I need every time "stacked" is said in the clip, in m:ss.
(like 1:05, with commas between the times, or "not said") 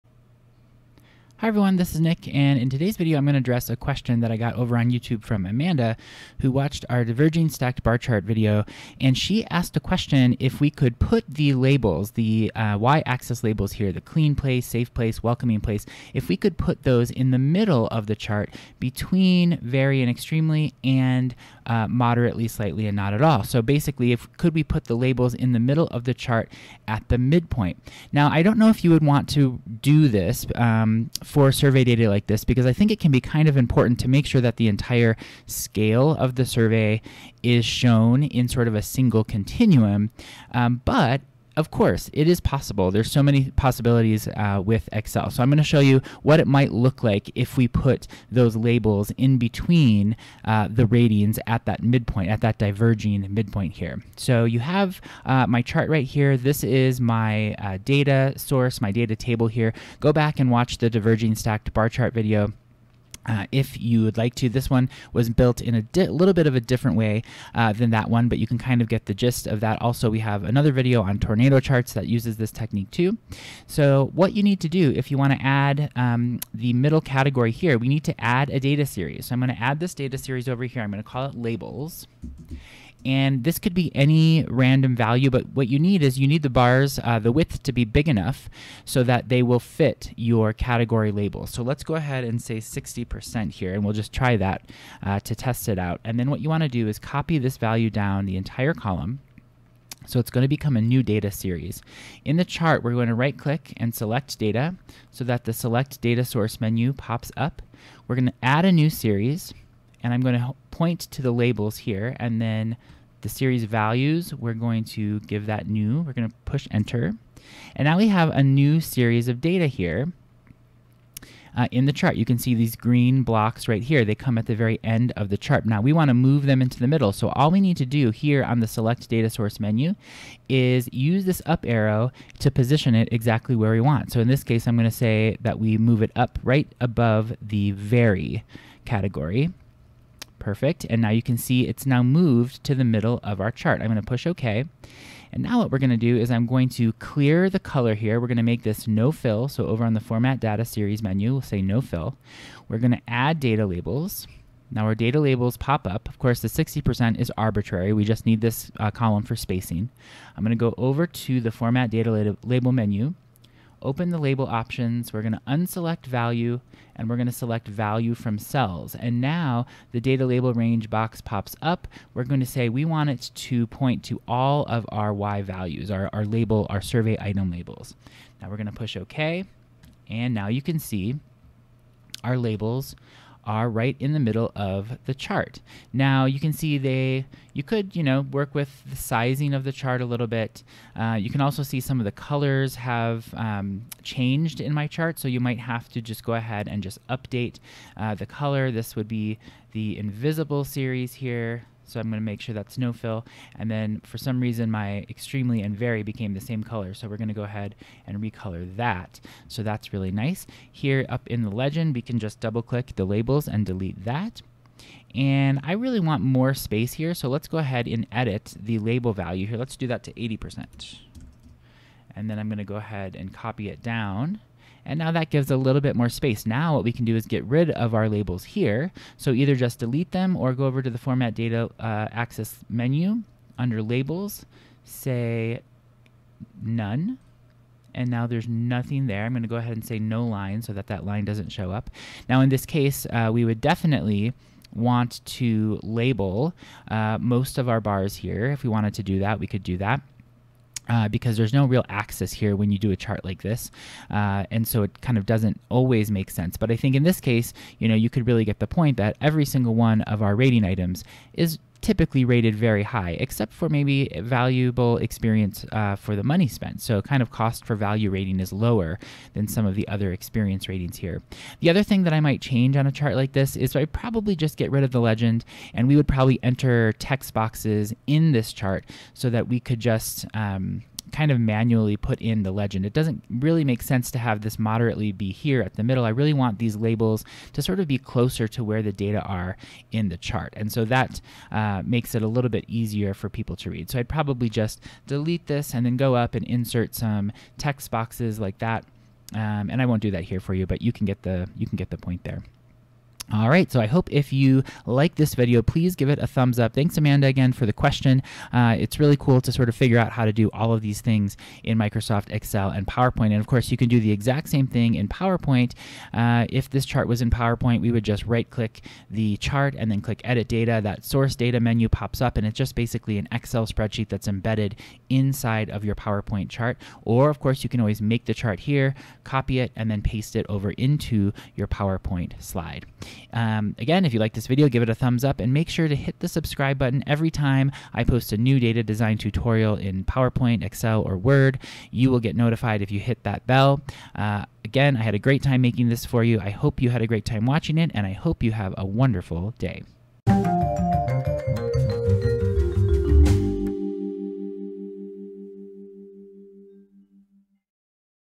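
0:07, 1:01.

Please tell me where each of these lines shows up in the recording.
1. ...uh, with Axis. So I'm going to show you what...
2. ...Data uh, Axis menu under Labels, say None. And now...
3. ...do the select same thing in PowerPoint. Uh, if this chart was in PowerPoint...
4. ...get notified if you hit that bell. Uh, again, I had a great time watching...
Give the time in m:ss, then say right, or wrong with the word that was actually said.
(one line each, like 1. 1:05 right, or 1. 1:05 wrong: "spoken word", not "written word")
1. 0:44 wrong: "Excel", not "Axis"
2. 3:51 right
3. 5:13 wrong: "exact", not "select"
4. 5:42 wrong: "making", not "watching".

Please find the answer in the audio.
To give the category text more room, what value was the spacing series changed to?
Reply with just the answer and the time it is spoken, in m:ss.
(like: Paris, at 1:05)
80%, at 3:40.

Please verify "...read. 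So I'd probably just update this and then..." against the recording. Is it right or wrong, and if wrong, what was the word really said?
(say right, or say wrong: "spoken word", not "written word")
wrong: "delete", not "update".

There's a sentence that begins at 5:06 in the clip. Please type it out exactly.
Thanks, Amanda, again for the question.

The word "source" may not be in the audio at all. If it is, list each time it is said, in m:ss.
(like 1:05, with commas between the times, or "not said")
0:58, 1:46, 2:09, 5:21.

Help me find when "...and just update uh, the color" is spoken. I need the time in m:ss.
3:16.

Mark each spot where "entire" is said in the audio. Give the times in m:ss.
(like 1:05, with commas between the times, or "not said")
0:34, 1:38.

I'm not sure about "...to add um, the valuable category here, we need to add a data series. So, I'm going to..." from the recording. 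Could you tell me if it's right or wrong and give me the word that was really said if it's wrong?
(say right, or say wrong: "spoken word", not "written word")
wrong: "middle", not "valuable".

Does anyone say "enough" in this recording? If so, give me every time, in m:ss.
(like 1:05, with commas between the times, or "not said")
1:28.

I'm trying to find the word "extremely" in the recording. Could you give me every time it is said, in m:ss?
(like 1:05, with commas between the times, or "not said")
0:20, 3:25.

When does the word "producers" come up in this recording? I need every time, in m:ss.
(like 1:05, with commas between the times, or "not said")
not said.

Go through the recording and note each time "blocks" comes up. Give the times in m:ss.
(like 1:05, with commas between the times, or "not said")
2:03.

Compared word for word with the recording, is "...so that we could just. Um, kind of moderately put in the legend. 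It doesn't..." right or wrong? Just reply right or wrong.
wrong.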